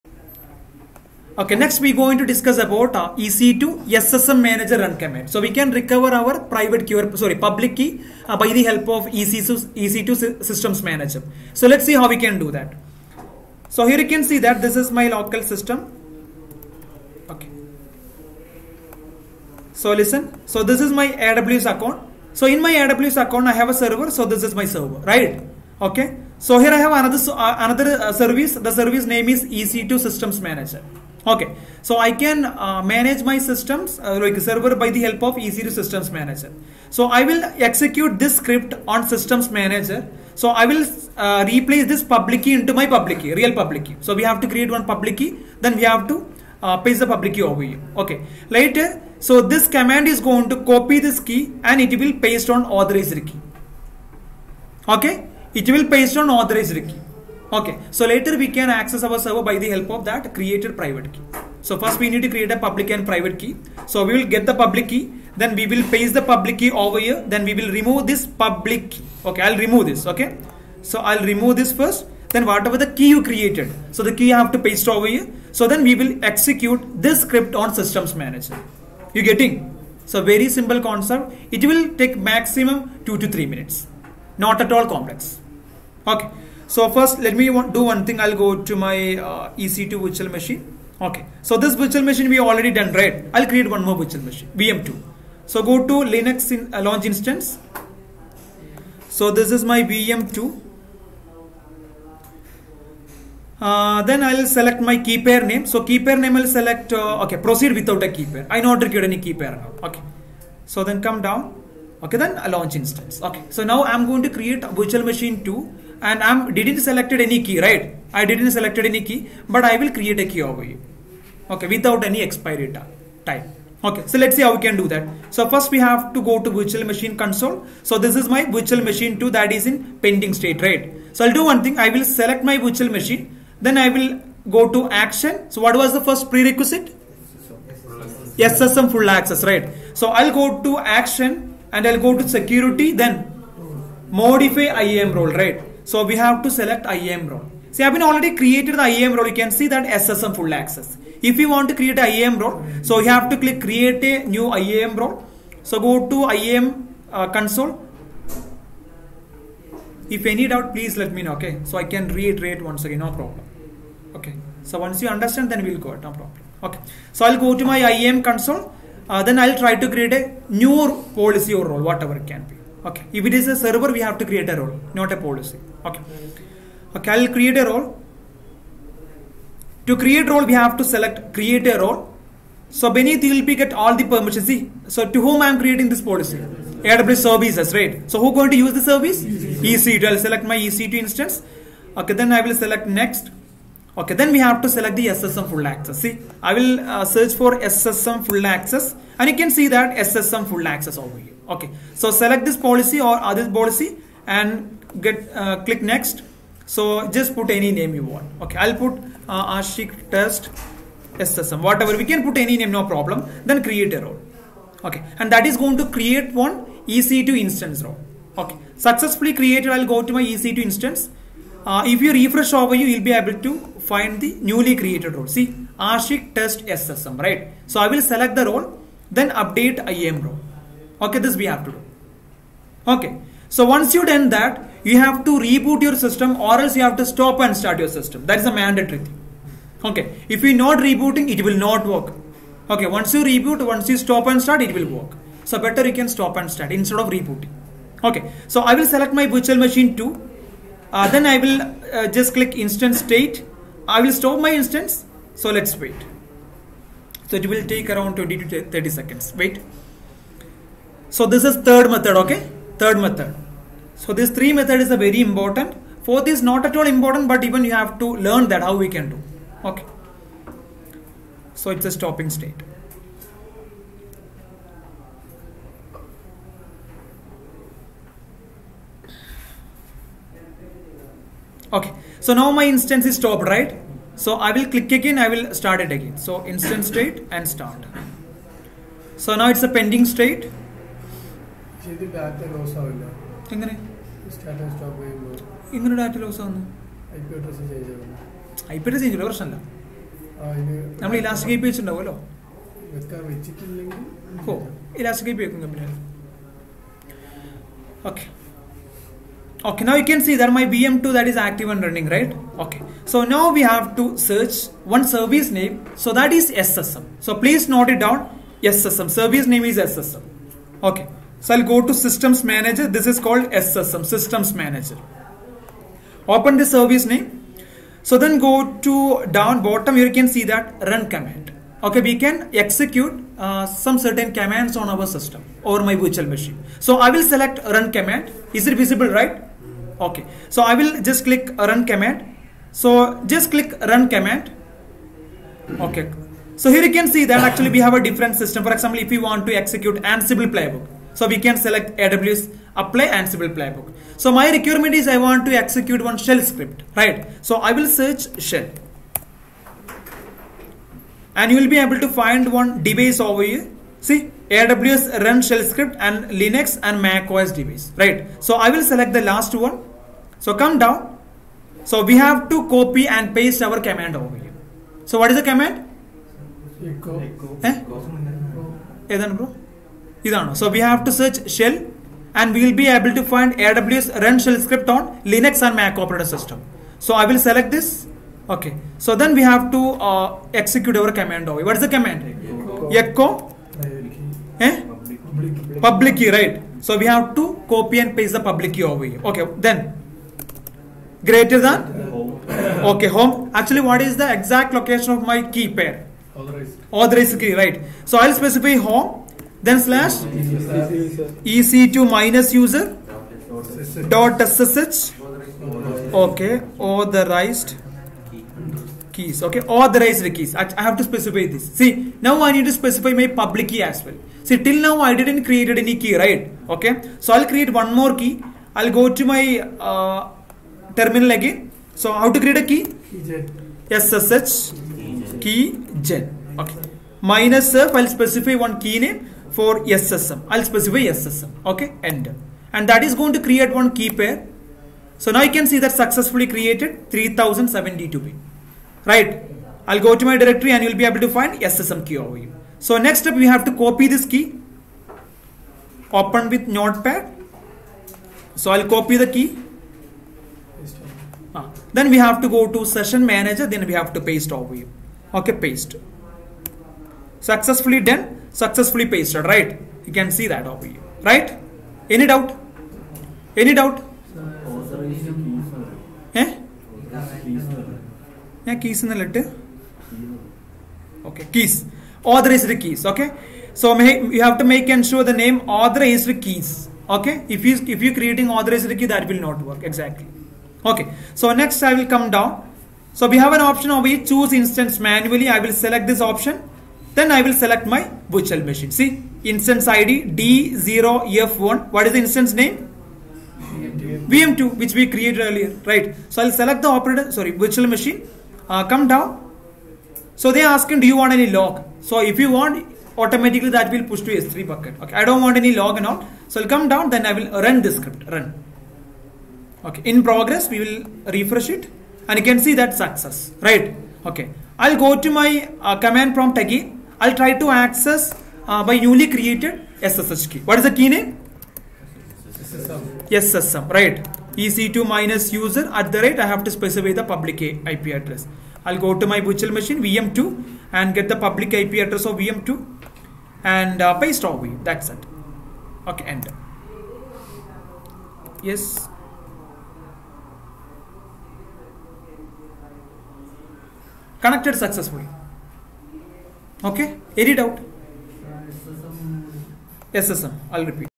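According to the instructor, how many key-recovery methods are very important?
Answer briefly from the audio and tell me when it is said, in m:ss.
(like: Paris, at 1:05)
3, at 4:24.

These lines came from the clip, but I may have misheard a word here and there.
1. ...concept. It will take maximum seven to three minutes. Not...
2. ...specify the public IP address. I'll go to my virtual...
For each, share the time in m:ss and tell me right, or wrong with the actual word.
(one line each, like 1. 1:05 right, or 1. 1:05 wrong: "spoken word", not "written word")
1. 1:20 wrong: "two", not "seven"
2. 8:56 right.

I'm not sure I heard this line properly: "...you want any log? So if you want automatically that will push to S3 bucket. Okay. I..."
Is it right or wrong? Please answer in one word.
right.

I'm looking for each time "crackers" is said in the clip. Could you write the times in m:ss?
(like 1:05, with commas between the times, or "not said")
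not said.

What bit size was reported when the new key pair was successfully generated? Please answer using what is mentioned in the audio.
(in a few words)
3072.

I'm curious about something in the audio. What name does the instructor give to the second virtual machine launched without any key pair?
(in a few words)
VM2.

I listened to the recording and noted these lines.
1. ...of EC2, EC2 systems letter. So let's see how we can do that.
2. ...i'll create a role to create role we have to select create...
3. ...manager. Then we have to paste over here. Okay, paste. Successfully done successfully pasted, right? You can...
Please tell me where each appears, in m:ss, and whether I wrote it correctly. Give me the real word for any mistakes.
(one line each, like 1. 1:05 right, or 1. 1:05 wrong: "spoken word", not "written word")
1. 0:08 wrong: "manager", not "letter"
2. 2:57 right
3. 7:43 right.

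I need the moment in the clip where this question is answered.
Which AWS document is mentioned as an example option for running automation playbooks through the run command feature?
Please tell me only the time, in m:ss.
5:51.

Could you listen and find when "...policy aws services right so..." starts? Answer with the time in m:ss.
3:06.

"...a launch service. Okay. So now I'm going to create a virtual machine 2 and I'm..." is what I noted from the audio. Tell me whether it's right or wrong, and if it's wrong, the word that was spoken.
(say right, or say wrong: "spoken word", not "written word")
wrong: "instance", not "service".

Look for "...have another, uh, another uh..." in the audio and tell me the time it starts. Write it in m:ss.
0:26.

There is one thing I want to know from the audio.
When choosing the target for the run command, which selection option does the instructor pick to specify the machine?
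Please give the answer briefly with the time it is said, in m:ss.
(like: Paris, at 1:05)
Choose instance manually, at 8:14.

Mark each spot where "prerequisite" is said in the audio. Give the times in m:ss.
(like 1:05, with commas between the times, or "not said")
2:16.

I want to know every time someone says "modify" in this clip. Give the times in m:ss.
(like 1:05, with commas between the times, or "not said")
2:24.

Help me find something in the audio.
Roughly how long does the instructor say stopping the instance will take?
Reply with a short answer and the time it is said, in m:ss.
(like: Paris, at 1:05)
20 to 30 seconds, at 4:18.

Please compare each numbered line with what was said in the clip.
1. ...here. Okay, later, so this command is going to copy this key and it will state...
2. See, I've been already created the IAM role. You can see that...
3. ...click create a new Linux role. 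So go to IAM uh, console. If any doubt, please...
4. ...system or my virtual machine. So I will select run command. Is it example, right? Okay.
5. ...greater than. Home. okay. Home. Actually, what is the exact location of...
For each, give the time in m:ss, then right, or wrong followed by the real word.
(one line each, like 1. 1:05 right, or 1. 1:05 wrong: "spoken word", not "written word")
1. 0:47 wrong: "paste", not "state"
2. 2:27 right
3. 2:33 wrong: "IAM", not "Linux"
4. 5:35 wrong: "visible", not "example"
5. 6:41 right.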